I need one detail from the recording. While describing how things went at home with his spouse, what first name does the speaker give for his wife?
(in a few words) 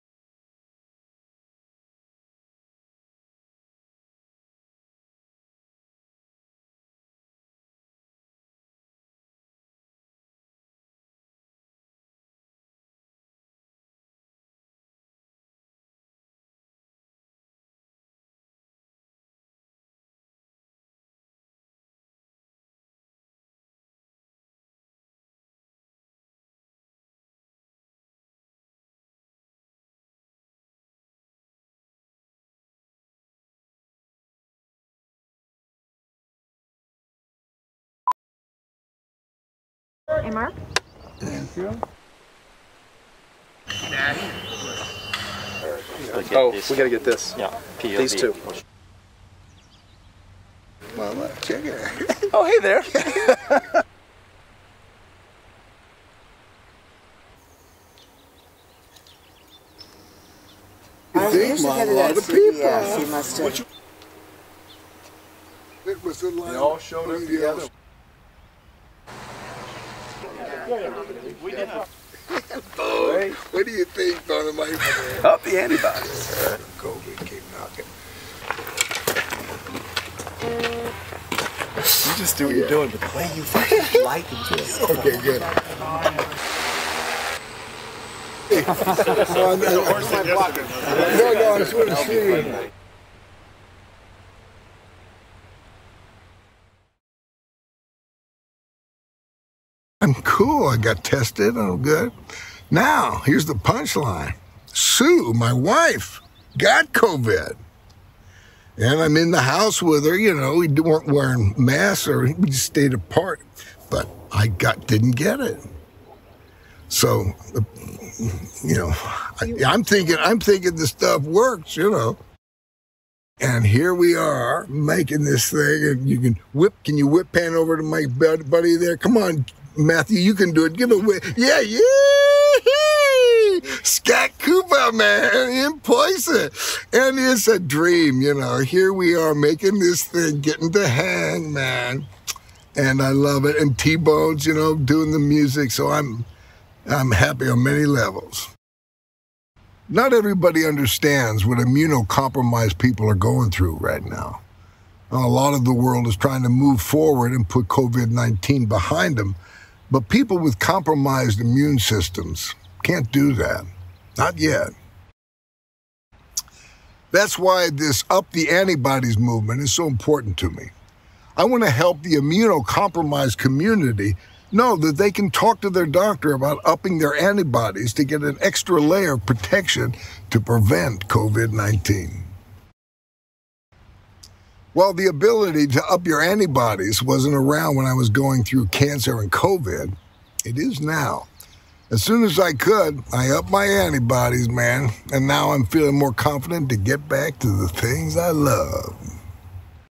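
Sue.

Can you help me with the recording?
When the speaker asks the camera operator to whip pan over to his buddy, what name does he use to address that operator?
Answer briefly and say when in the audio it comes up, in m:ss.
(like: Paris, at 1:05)
Matthew, at 2:09.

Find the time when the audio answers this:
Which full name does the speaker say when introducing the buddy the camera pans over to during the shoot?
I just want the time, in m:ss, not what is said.
2:13.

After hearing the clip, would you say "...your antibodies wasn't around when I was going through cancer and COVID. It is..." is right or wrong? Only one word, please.
right.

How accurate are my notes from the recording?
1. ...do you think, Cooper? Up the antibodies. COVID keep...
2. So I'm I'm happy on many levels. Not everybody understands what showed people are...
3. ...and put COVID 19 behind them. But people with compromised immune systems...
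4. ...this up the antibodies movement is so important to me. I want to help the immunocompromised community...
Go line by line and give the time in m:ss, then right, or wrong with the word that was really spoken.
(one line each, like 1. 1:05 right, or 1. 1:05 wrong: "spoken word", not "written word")
1. 1:13 wrong: "Mike", not "Cooper"
2. 2:25 wrong: "immunocompromised", not "showed"
3. 2:37 right
4. 2:47 right.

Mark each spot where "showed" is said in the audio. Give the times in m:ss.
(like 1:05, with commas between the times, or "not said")
1:06.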